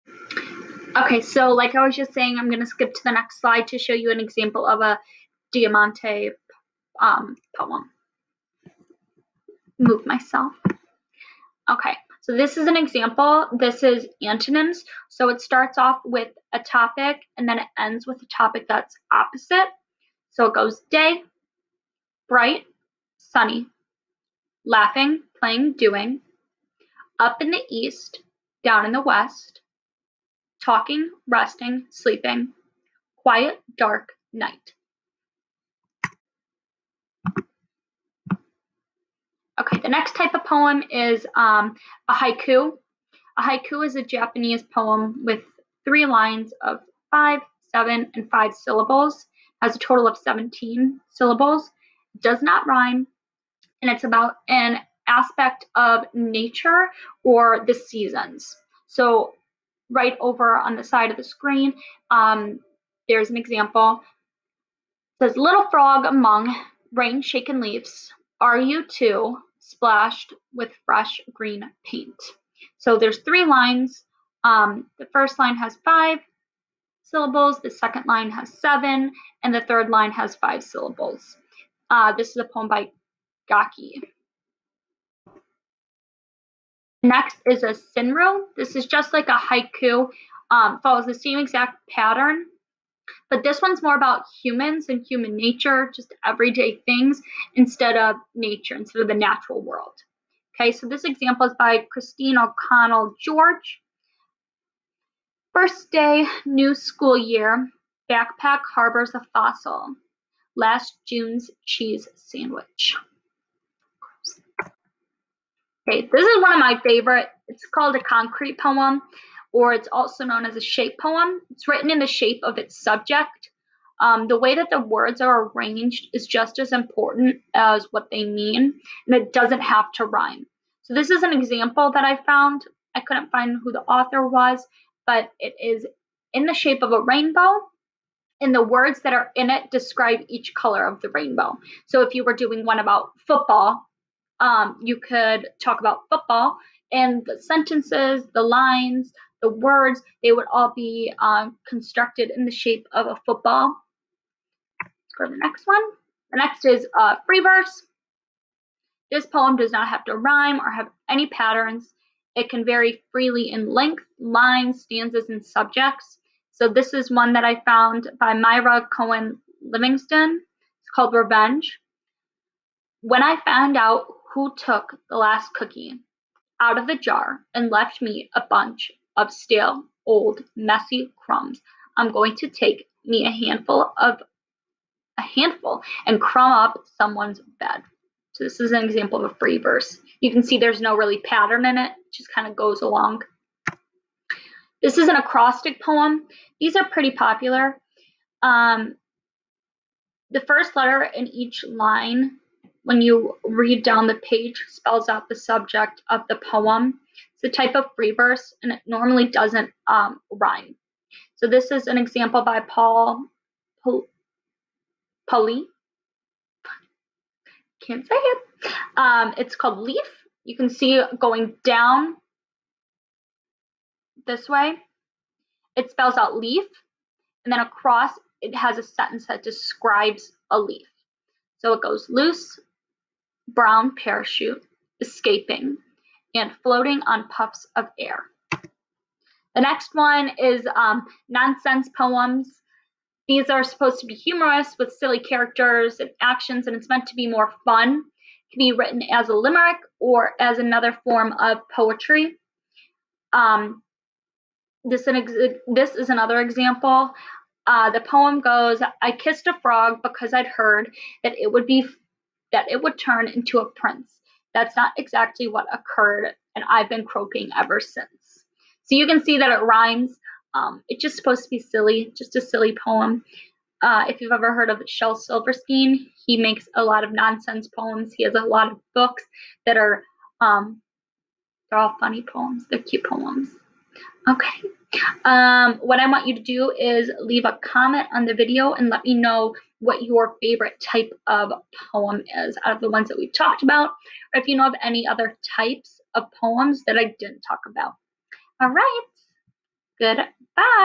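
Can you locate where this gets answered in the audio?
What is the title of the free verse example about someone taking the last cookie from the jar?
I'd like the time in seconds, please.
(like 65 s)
171 s.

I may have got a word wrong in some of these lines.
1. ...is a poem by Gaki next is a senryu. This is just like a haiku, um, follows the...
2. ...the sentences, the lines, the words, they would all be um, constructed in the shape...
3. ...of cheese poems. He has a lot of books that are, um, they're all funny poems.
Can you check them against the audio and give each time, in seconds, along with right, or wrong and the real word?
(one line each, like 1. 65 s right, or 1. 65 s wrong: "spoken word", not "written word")
1. 82 s right
2. 147 s right
3. 277 s wrong: "nonsense", not "cheese".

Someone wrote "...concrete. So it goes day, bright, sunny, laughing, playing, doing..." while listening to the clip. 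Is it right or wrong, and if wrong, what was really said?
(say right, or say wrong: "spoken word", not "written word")
wrong: "opposite", not "concrete".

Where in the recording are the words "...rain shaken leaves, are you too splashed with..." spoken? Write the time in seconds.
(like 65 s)
66 s.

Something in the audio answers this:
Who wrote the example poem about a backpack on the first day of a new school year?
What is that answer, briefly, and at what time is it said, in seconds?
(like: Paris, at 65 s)
Kristine O'Connell George, at 101 s.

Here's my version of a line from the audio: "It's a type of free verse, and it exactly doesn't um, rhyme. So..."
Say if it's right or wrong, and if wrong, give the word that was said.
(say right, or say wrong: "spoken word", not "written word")
wrong: "normally", not "exactly".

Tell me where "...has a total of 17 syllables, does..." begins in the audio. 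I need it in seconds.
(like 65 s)
49 s.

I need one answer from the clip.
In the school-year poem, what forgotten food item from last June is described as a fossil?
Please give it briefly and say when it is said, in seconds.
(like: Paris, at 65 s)
cheese sandwich, at 111 s.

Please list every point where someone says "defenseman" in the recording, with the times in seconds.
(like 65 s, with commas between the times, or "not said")
not said.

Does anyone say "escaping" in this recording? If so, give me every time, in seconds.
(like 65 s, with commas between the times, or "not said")
234 s.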